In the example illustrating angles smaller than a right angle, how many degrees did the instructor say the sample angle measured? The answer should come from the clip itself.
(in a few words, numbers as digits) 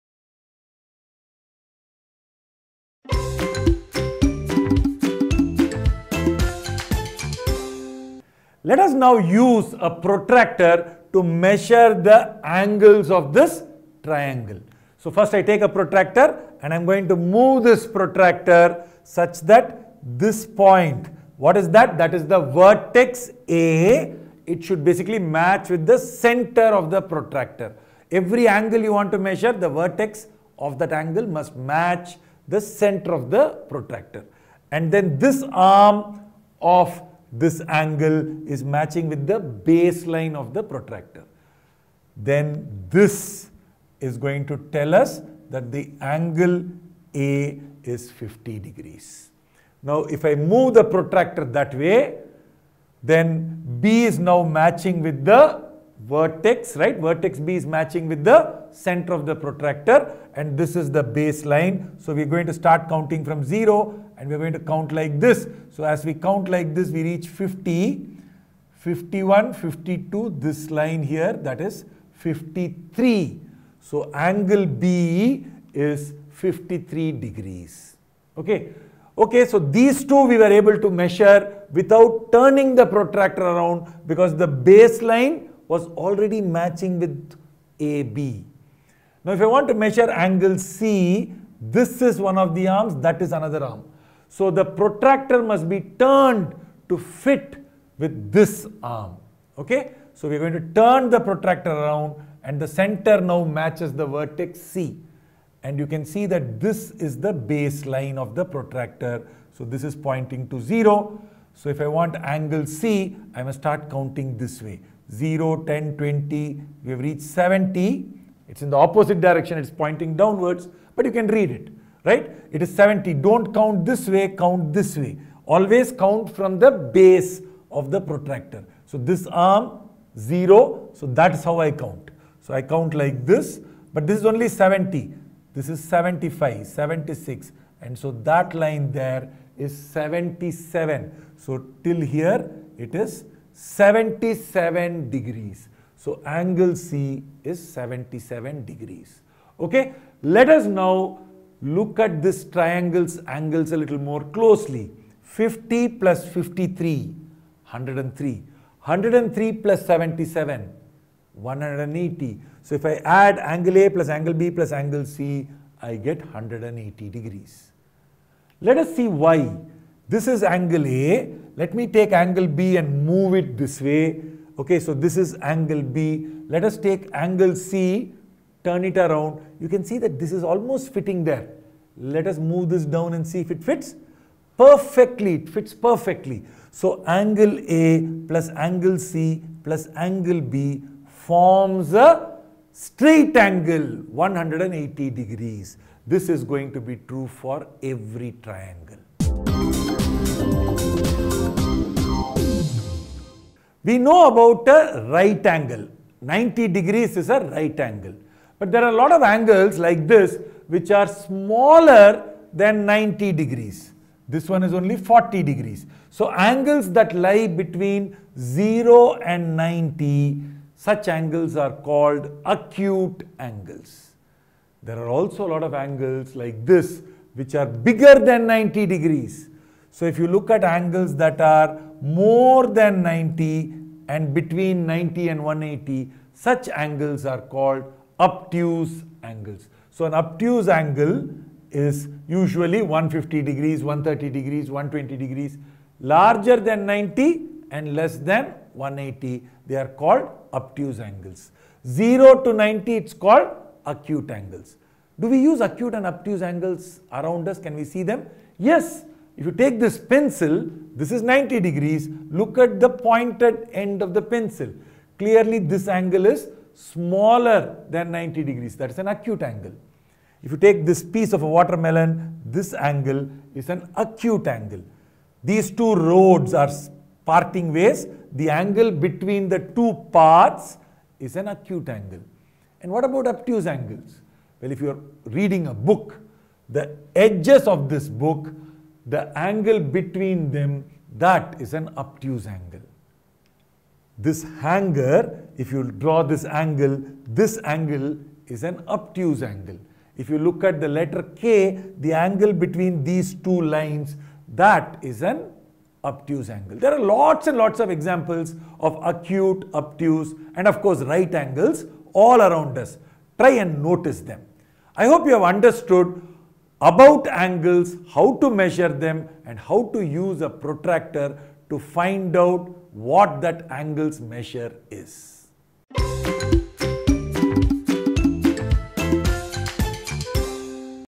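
40 degrees.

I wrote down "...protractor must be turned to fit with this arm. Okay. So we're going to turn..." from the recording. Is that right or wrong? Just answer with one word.
right.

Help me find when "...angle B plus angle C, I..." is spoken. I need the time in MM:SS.
02:44.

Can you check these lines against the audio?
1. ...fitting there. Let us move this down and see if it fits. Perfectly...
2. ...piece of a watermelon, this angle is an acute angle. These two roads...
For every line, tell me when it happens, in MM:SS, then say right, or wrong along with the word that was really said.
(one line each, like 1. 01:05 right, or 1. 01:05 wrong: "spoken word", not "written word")
1. 03:00 right
2. 04:31 right.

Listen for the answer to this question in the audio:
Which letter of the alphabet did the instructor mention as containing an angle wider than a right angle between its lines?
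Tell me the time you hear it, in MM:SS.
05:01.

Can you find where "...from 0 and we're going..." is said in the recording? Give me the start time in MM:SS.
01:03.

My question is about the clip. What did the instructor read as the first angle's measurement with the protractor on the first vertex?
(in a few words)
50 degrees.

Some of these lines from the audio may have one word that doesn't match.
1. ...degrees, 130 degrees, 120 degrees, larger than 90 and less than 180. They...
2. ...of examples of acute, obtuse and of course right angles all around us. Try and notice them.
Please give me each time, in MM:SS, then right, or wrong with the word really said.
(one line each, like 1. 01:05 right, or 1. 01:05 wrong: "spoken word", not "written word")
1. 04:03 right
2. 05:07 right.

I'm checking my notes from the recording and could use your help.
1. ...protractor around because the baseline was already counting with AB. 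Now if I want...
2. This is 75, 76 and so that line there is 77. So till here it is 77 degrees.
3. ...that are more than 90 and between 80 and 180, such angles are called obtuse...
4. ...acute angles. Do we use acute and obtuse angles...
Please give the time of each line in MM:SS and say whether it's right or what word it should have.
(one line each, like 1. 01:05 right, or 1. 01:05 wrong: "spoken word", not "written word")
1. 01:22 wrong: "matching", not "counting"
2. 02:15 right
3. 03:51 wrong: "90", not "80"
4. 04:13 right.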